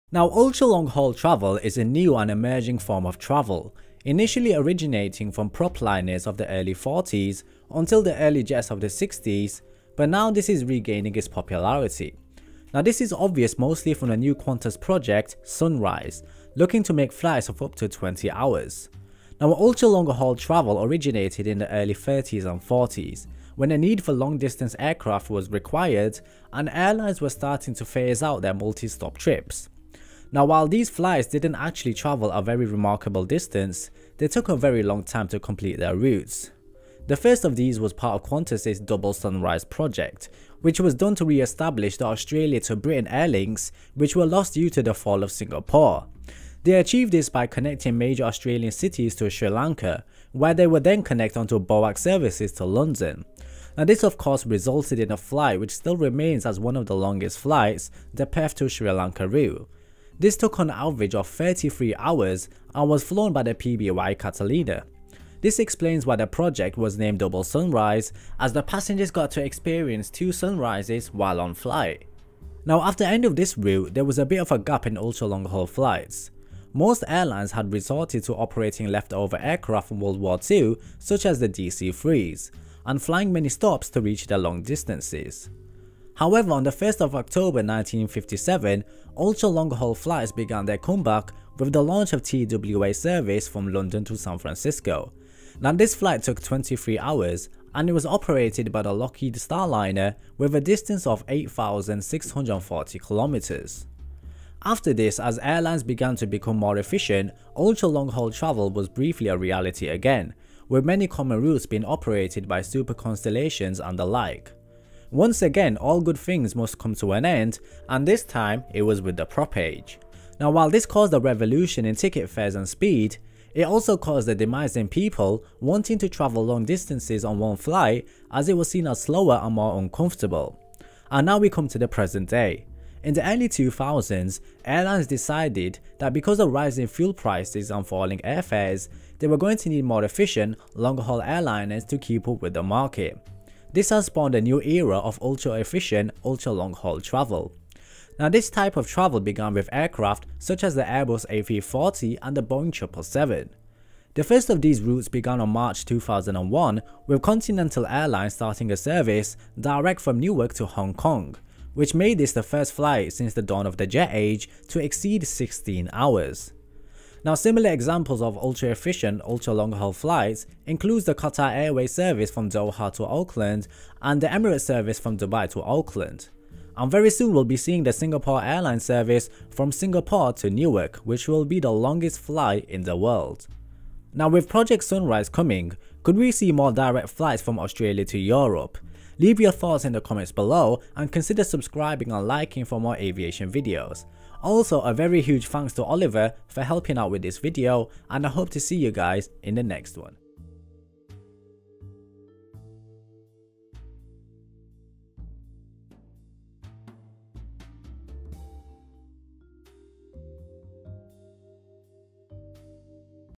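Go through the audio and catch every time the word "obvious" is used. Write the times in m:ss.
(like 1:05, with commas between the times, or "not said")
0:13.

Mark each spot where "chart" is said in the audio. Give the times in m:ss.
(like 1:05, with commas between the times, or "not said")
not said.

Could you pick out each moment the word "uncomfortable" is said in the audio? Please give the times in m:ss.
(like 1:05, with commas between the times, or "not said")
2:09.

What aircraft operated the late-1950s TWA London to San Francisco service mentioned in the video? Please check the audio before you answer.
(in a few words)
Lockheed Starliner.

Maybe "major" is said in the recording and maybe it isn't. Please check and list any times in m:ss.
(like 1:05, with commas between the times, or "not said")
0:47.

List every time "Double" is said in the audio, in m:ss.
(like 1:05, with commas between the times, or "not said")
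0:38, 1:07.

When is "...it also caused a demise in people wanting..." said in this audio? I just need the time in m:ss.
2:03.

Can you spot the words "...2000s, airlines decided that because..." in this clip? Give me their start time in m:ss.
2:13.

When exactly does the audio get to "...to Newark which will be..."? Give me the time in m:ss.
3:00.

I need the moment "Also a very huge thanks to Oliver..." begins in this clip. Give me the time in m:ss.
3:14.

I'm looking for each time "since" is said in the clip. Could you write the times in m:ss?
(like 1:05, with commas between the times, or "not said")
2:43.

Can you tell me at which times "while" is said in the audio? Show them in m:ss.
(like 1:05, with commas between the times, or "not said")
0:30, 1:11, 2:00.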